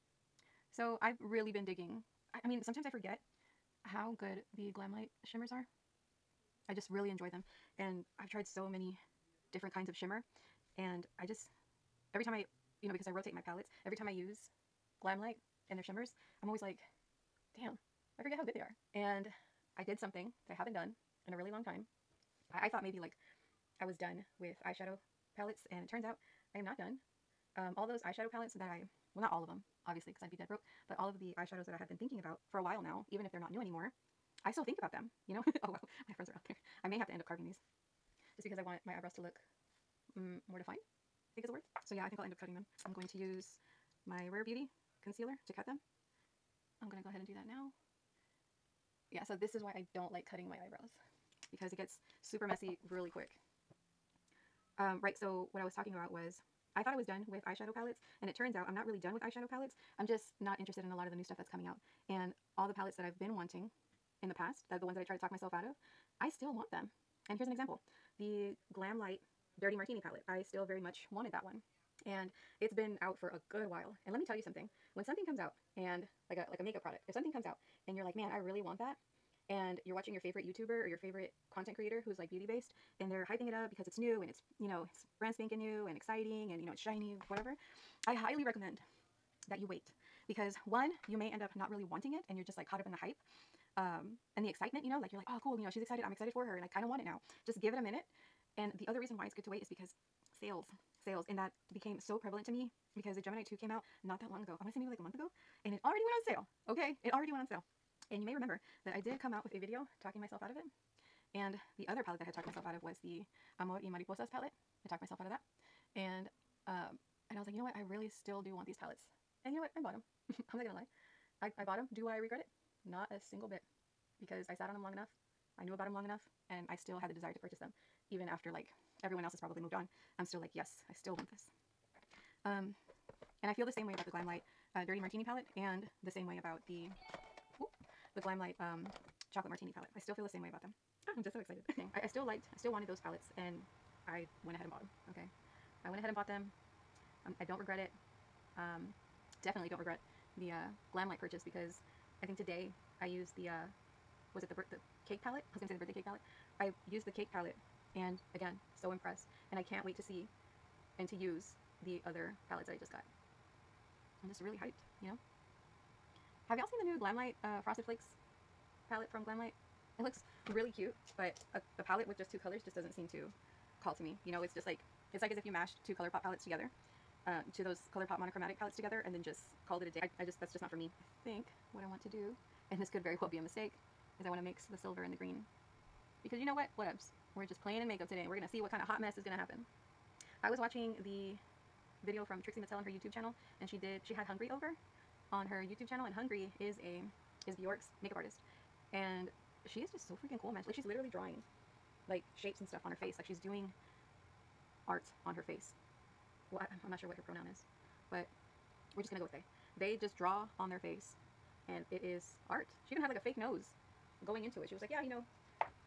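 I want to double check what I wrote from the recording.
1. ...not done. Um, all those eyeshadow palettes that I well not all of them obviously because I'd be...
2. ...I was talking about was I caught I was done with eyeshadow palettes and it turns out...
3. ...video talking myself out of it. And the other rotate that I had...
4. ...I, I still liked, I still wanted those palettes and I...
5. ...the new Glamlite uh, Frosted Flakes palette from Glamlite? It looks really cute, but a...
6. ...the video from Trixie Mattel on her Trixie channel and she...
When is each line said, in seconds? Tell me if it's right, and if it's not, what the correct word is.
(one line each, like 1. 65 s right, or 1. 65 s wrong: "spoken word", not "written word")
1. 26 s right
2. 55 s wrong: "thought", not "caught"
3. 109 s wrong: "palette", not "rotate"
4. 141 s right
5. 166 s right
6. 191 s wrong: "YouTube", not "Trixie".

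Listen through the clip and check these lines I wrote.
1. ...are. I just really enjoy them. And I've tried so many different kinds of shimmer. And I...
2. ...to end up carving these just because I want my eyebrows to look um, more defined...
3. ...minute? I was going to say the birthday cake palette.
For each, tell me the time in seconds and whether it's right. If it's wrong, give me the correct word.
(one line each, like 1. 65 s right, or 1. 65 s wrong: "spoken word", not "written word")
1. 5 s right
2. 37 s right
3. 155 s wrong: "palette", not "minute".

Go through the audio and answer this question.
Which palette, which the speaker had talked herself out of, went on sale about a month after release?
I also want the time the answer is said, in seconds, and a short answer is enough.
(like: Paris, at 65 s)
Gemini 2, at 103 s.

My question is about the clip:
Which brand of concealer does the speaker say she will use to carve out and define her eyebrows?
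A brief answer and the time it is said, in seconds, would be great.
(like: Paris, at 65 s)
Rare Beauty, at 44 s.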